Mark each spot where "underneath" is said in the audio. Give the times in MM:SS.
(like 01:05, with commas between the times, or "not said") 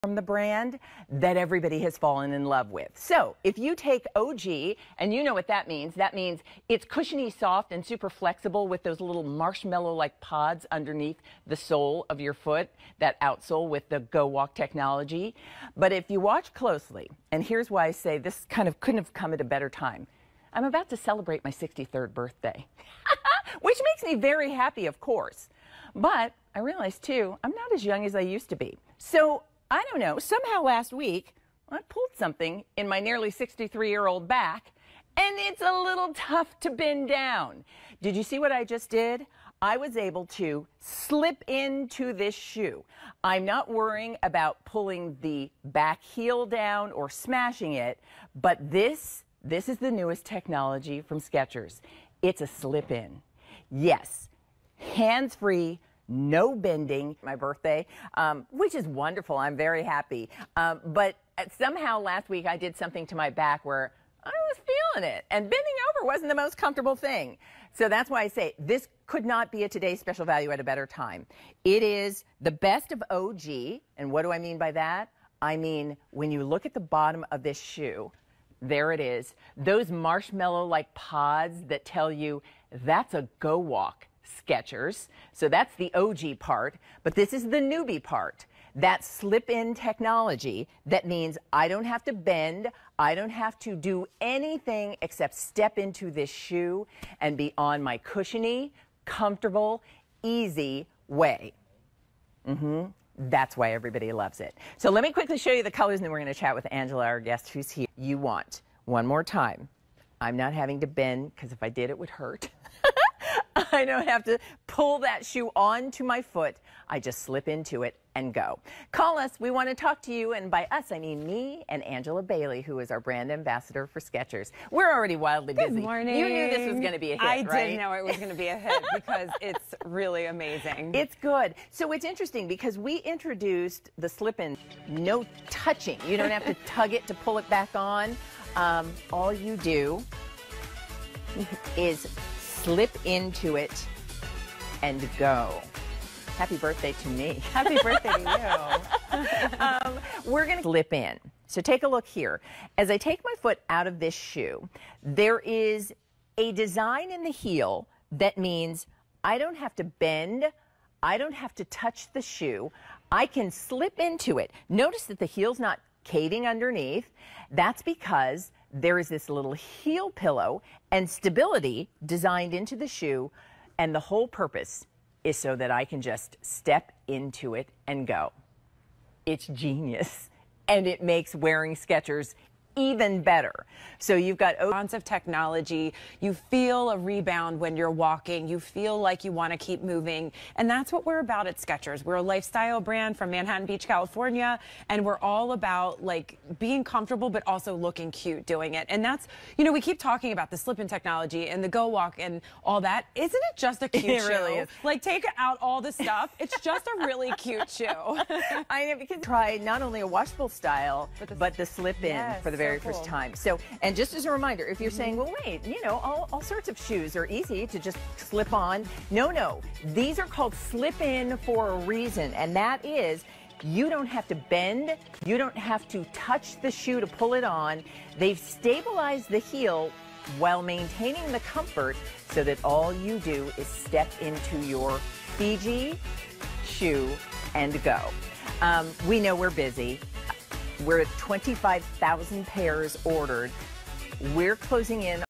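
00:10, 02:46.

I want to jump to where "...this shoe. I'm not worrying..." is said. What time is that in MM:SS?
00:42.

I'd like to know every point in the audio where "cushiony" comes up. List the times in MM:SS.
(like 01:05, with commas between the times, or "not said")
00:06, 01:37.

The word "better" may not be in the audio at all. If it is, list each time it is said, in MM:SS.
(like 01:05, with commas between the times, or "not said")
00:19, 01:10, 03:03.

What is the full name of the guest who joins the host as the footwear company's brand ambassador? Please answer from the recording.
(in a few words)
Angela Bailey.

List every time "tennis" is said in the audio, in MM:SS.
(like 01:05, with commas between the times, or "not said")
not said.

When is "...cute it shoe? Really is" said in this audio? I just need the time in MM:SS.
03:23.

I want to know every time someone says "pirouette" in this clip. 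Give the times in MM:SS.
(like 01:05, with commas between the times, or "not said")
not said.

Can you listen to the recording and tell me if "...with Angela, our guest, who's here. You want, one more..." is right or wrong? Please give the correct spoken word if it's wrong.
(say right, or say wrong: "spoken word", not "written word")
right.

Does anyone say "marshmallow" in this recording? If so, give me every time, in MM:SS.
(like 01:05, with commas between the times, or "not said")
00:09, 01:19.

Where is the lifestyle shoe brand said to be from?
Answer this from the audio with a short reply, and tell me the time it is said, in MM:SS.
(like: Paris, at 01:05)
Manhattan Beach, California, at 03:13.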